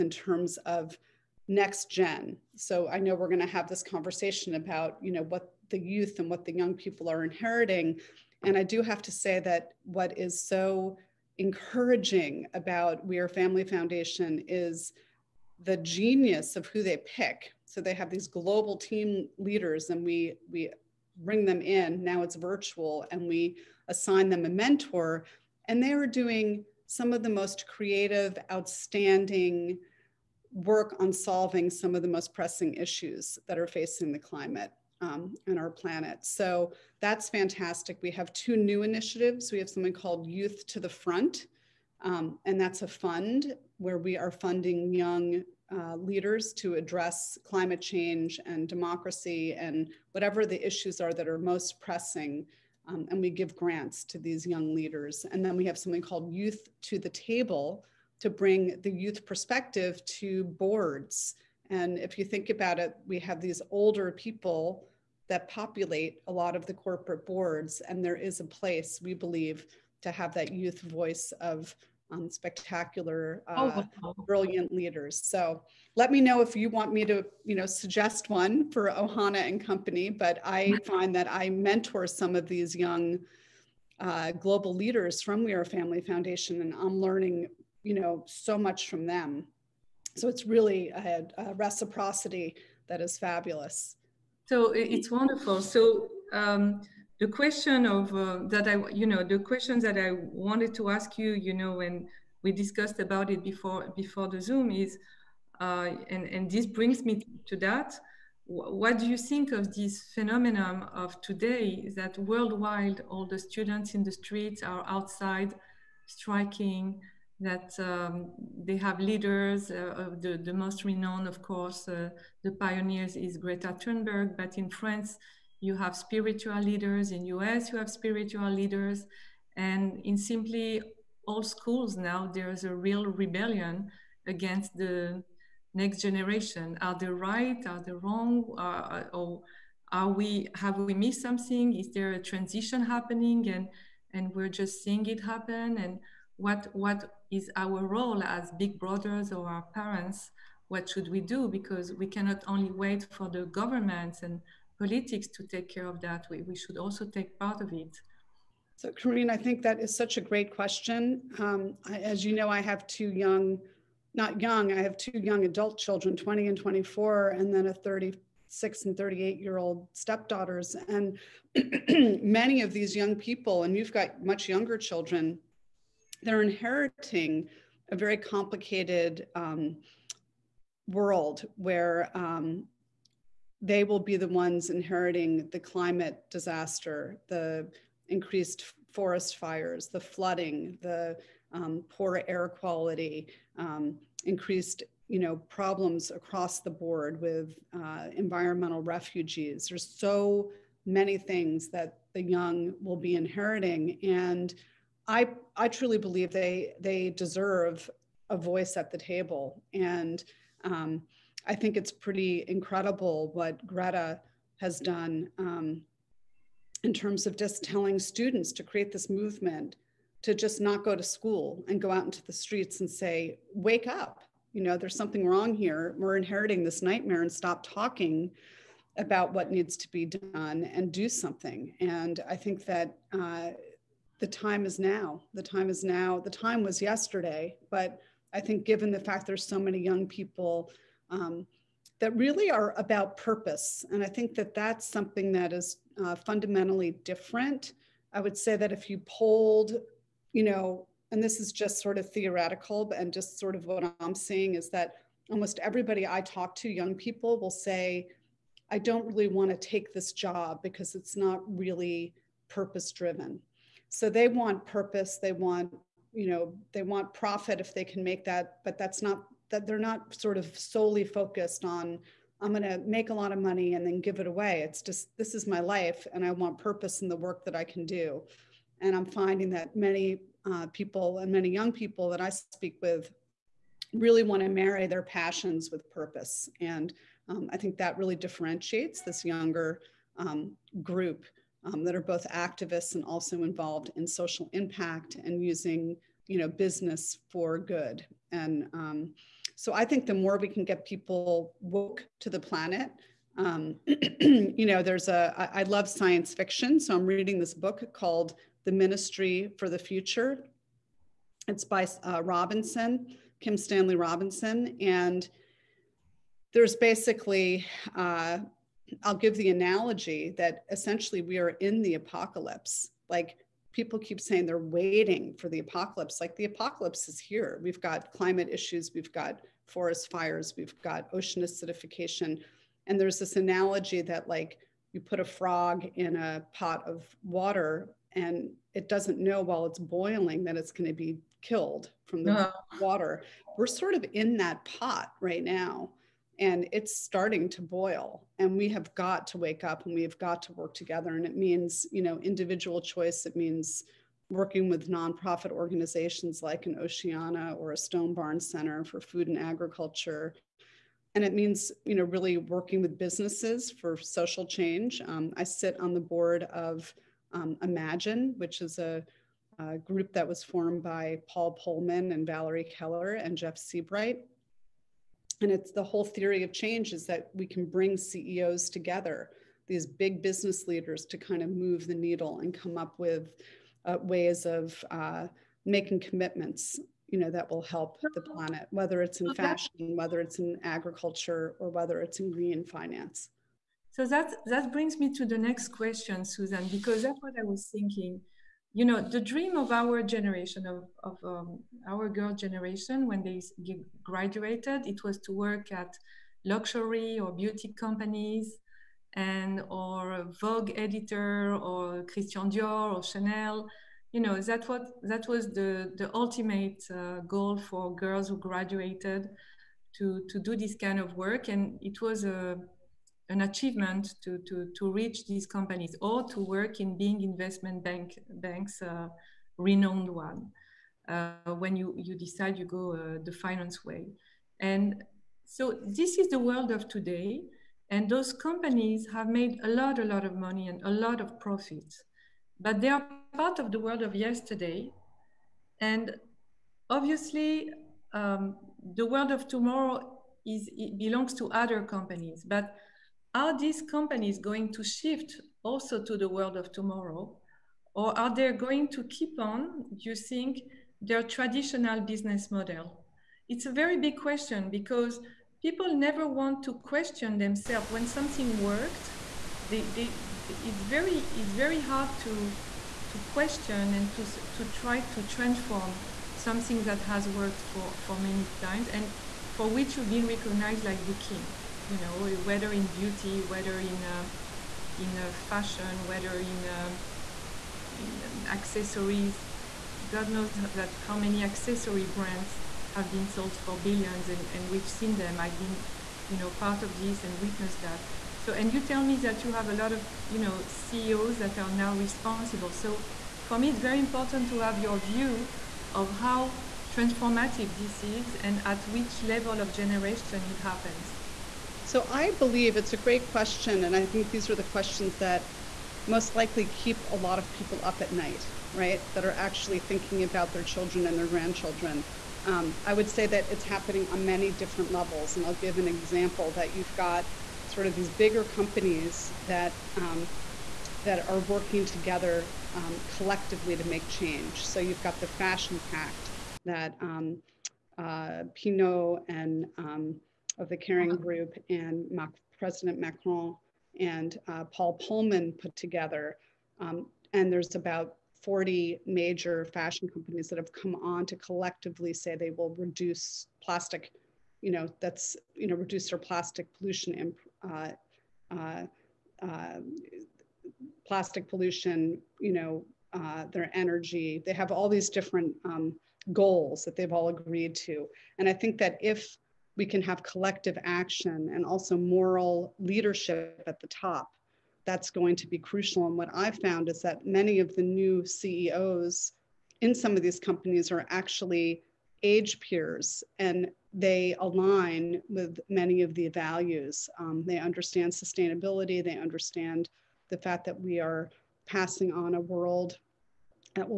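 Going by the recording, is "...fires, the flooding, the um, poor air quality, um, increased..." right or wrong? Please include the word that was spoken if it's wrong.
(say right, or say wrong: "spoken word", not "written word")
right.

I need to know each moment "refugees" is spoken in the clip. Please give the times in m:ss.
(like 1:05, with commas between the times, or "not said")
3:18.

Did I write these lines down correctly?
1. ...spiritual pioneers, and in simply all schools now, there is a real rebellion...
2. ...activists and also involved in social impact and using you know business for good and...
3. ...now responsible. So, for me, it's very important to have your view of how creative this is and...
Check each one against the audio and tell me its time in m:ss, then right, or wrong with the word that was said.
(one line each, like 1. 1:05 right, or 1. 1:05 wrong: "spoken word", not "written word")
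1. 2:07 wrong: "leaders", not "pioneers"
2. 4:52 right
3. 8:21 wrong: "transformative", not "creative".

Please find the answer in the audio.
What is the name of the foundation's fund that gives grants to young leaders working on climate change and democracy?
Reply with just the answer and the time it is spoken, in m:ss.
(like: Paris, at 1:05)
Youth to the Front, at 0:40.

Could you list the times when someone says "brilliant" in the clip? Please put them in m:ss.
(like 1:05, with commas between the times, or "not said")
1:14.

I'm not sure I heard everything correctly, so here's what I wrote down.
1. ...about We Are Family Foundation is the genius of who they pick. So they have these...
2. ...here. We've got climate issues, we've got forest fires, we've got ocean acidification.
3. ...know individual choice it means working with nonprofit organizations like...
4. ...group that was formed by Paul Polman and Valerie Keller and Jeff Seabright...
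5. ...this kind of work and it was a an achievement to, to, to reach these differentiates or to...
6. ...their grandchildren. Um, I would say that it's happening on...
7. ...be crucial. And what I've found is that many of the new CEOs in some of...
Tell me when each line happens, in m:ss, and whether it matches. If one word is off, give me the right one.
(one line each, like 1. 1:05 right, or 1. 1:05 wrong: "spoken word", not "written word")
1. 0:12 right
2. 5:27 right
3. 5:52 right
4. 6:09 right
5. 7:00 wrong: "companies", not "differentiates"
6. 8:41 right
7. 9:35 right.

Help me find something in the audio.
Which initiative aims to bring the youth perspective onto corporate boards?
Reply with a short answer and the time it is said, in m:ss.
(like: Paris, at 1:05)
Youth to the Table, at 0:56.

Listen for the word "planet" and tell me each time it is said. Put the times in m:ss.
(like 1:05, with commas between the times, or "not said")
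0:35, 5:02, 6:28.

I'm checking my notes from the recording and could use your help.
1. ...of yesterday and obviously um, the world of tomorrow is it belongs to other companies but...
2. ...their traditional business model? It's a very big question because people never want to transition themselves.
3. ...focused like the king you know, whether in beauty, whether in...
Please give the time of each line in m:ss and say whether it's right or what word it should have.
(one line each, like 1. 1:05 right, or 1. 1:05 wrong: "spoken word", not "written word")
1. 7:24 right
2. 7:41 wrong: "question", not "transition"
3. 8:00 wrong: "recognized", not "focused".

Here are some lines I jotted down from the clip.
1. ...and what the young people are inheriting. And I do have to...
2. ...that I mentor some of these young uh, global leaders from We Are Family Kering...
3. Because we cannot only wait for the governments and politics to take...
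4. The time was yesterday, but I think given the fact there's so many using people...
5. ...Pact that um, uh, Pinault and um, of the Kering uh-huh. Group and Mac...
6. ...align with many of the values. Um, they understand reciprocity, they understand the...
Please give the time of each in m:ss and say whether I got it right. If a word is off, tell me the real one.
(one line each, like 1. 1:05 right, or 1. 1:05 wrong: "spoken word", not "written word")
1. 0:06 right
2. 1:21 wrong: "Foundation", not "Kering"
3. 2:31 right
4. 3:56 wrong: "young", not "using"
5. 8:55 right
6. 9:44 wrong: "sustainability", not "reciprocity".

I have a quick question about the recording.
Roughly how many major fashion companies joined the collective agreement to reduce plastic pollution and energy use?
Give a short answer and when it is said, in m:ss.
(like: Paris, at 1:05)
40, at 9:08.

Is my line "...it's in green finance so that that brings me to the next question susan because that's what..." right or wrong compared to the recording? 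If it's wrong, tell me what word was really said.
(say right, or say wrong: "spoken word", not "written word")
right.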